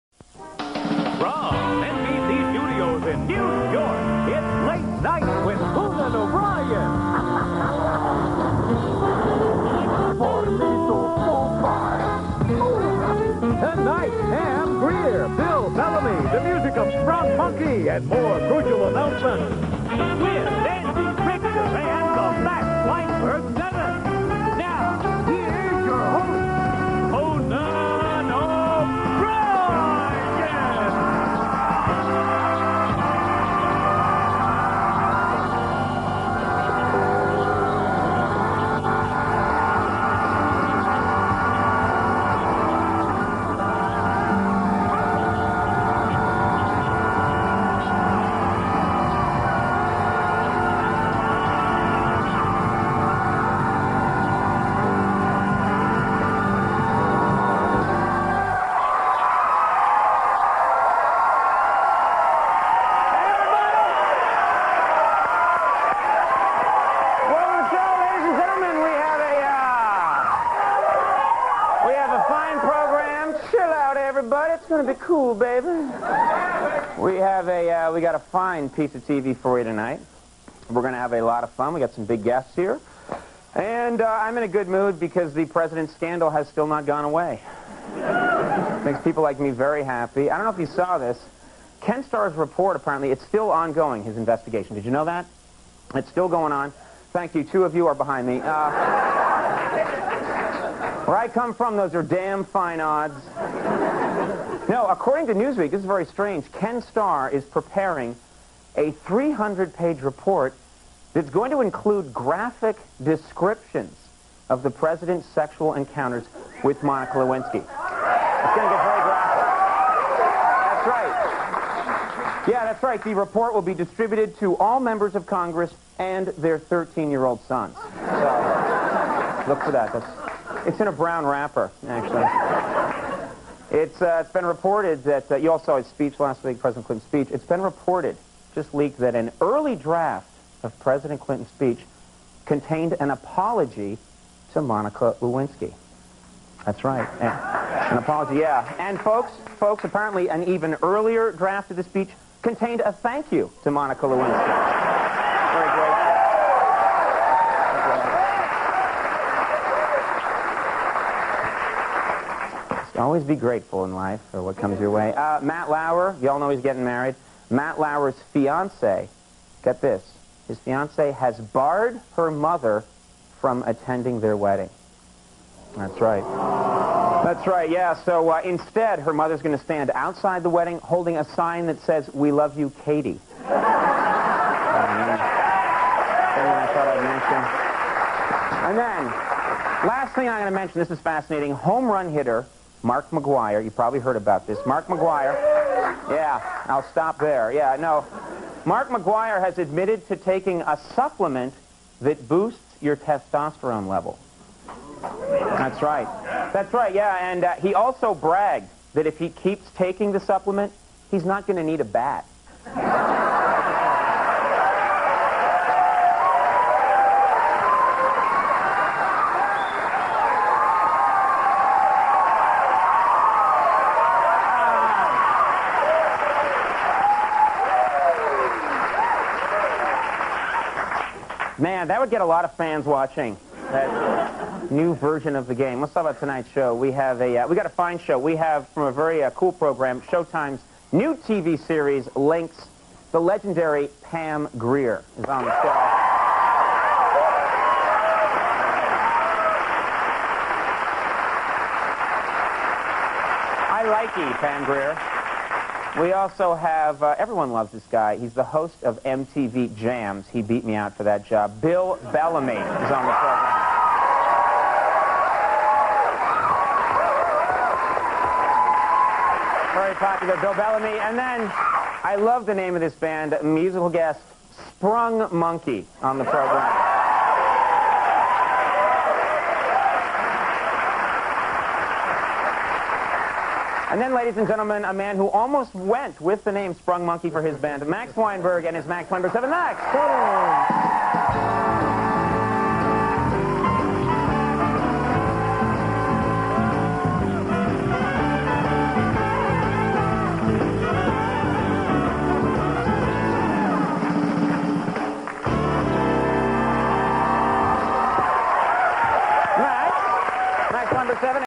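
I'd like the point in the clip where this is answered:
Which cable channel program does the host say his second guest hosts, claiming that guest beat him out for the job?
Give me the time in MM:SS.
04:19.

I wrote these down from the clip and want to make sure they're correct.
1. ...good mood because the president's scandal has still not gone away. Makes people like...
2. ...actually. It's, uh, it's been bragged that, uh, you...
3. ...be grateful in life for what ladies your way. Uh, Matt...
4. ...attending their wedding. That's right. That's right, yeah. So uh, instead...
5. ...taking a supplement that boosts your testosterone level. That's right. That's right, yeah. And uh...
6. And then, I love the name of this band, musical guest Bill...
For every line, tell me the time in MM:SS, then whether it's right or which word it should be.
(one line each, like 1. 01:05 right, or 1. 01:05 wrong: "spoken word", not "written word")
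1. 01:24 right
2. 02:11 wrong: "reported", not "bragged"
3. 02:43 wrong: "comes", not "ladies"
4. 02:53 right
5. 03:20 right
6. 04:30 wrong: "Sprung", not "Bill".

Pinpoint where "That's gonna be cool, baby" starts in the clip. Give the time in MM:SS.
01:14.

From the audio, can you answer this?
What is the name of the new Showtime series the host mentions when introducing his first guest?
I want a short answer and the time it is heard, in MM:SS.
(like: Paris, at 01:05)
Linc's, at 04:02.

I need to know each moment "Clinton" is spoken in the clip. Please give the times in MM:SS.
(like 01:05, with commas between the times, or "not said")
02:16, 02:21.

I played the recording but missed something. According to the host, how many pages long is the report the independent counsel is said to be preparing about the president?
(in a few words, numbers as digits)
300.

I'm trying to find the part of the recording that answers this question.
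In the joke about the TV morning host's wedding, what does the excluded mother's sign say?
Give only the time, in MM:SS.
03:02.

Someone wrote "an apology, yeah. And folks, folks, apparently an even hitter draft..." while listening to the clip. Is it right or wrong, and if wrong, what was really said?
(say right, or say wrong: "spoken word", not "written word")
wrong: "earlier", not "hitter".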